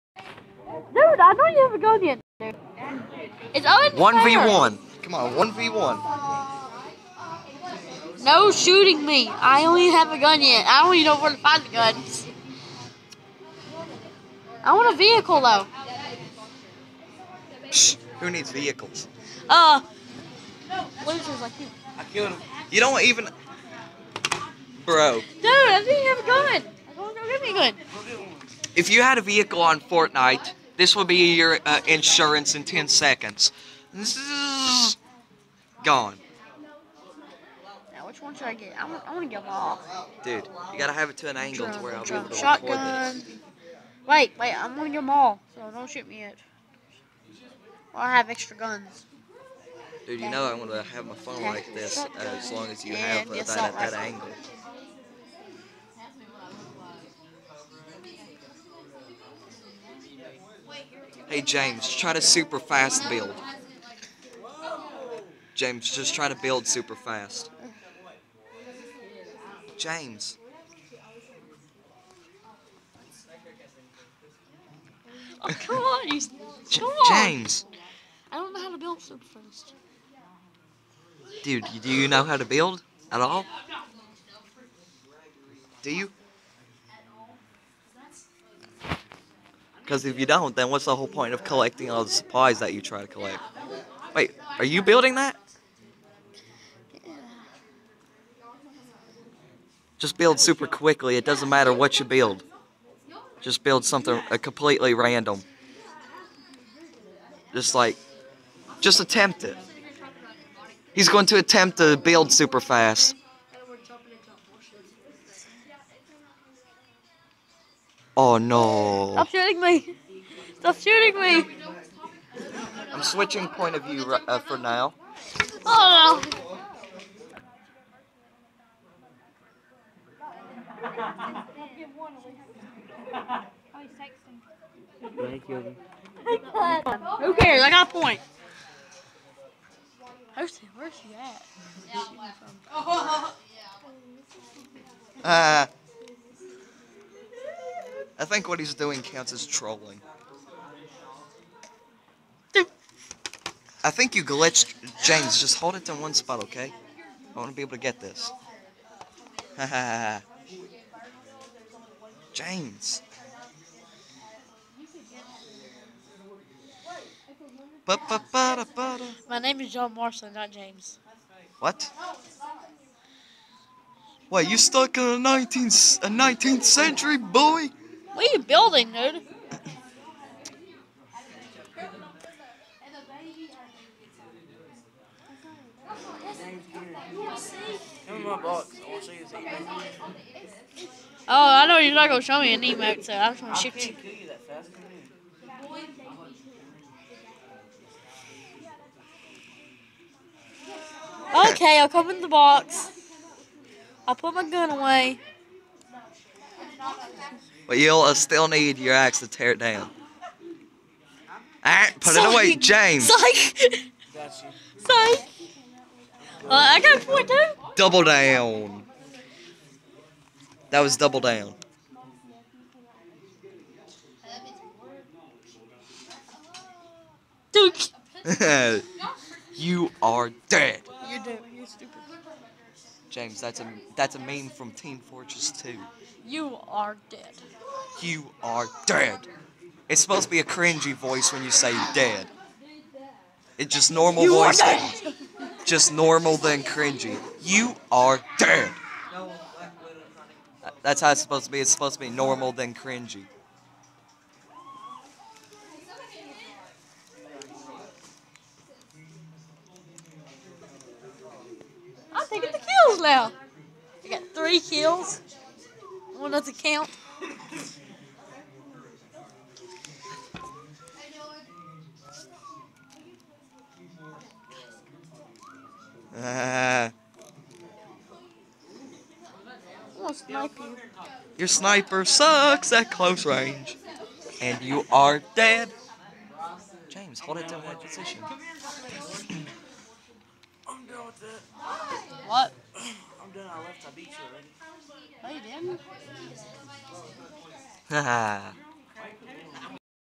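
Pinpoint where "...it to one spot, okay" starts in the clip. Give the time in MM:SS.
02:35.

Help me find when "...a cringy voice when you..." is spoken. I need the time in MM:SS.
04:00.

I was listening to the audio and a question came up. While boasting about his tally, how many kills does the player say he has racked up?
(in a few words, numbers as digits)
3.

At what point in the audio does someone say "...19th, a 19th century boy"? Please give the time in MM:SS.
02:55.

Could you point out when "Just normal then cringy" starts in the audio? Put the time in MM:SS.
04:05.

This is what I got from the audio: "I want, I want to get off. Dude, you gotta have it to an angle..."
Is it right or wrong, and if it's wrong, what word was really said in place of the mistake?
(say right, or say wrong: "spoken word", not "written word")
right.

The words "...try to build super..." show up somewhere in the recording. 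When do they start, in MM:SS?
01:06.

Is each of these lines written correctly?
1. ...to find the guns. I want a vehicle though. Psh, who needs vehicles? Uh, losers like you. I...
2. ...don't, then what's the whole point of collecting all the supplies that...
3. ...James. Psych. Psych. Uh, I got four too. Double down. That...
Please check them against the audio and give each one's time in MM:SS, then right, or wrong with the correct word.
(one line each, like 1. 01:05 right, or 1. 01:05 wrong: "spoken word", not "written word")
1. 00:11 right
2. 01:30 right
3. 03:32 right.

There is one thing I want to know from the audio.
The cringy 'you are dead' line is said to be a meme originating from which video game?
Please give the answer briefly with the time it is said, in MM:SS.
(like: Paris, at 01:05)
Team Fortress 2, at 03:54.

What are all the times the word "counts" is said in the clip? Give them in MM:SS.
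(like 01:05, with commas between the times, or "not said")
02:29, 04:26.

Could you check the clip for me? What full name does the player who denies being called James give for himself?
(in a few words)
John Marshall.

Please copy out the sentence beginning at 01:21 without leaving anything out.
Dude, do you know how to build at all?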